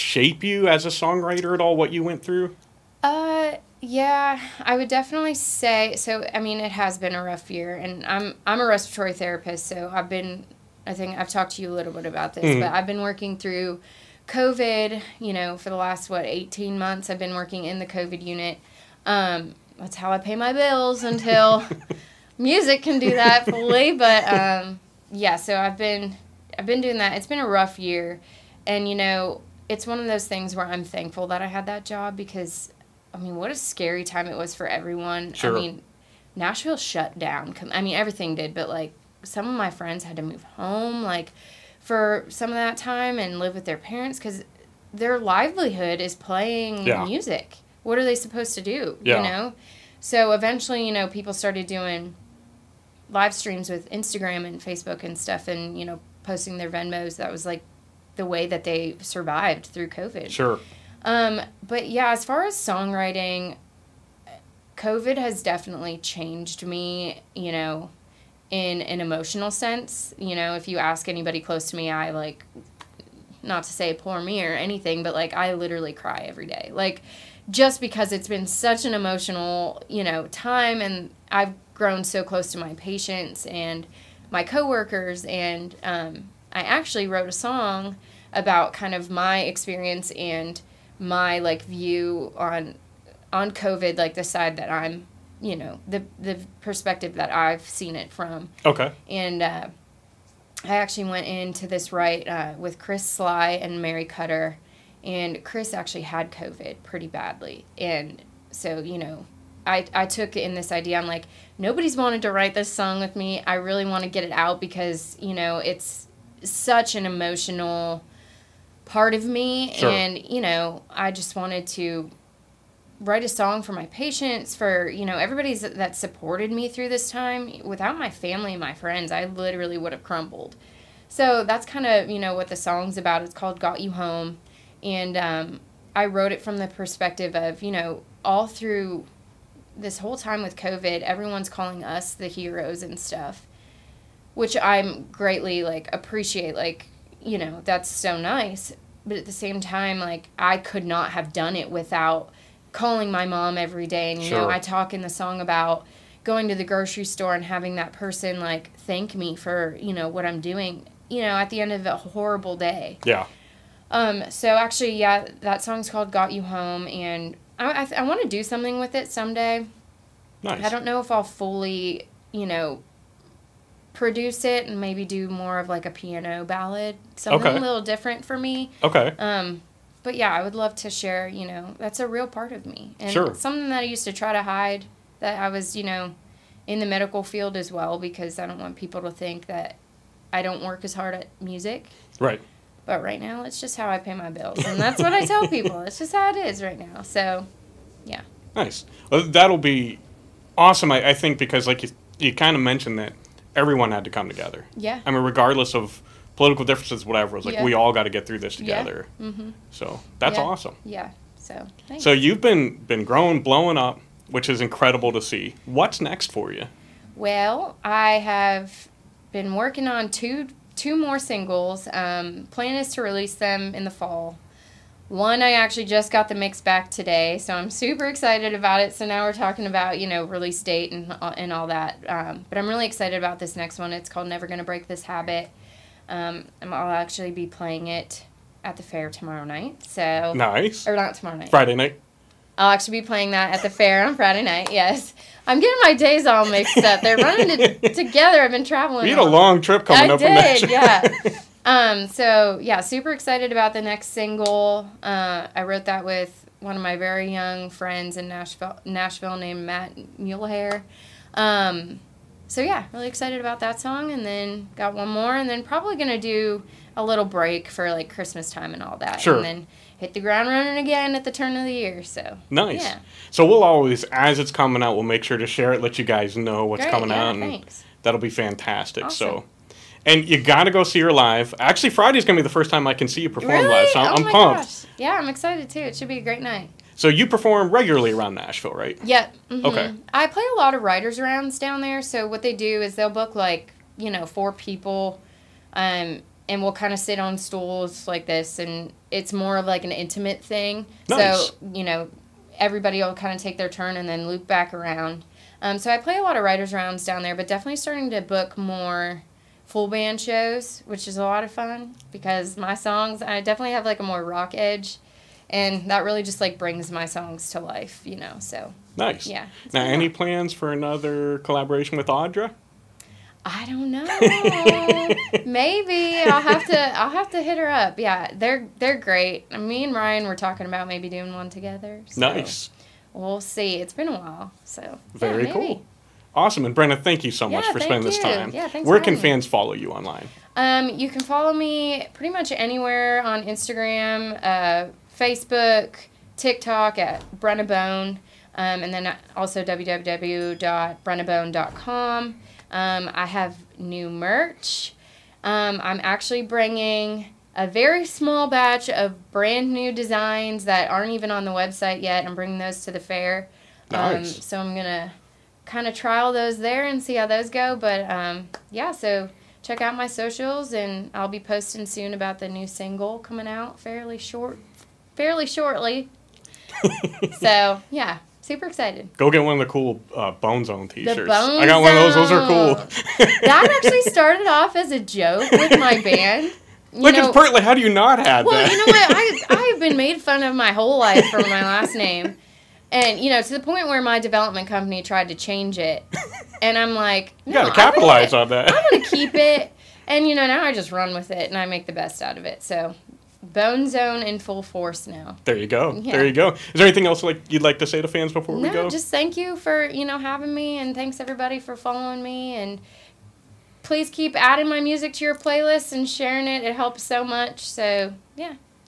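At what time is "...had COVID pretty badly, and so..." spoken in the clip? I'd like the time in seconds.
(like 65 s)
106 s.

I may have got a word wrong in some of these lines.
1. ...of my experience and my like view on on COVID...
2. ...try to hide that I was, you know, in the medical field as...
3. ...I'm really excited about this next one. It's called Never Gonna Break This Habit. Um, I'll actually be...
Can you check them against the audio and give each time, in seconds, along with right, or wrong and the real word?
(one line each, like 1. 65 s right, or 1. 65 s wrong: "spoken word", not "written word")
1. 88 s right
2. 184 s right
3. 232 s right.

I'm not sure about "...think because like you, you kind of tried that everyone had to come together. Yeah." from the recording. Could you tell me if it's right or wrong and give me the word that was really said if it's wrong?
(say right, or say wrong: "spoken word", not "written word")
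wrong: "mentioned", not "tried".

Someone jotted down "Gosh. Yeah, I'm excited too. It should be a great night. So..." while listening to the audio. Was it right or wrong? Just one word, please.
right.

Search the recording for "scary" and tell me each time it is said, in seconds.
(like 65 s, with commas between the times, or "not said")
33 s.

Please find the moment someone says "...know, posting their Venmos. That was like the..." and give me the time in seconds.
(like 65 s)
55 s.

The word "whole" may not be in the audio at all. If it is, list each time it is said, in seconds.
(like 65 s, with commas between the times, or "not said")
139 s, 390 s.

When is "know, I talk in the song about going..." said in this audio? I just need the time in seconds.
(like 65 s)
154 s.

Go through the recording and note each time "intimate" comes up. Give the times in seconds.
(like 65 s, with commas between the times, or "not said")
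299 s.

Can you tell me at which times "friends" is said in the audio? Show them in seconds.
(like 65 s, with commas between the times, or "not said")
39 s, 128 s, 257 s.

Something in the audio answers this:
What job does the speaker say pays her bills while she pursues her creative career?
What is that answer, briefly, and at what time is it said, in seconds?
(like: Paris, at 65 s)
Respiratory therapist, at 8 s.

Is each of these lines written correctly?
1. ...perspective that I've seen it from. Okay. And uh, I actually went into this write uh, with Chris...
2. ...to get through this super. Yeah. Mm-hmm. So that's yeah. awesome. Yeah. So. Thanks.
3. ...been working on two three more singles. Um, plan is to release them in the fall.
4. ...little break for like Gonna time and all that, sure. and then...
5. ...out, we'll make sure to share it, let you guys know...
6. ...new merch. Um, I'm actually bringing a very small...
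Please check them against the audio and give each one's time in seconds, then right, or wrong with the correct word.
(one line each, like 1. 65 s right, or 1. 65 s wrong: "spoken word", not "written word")
1. 96 s right
2. 208 s wrong: "together", not "super"
3. 219 s wrong: "two", not "three"
4. 267 s wrong: "Christmas", not "Gonna"
5. 274 s right
6. 353 s right.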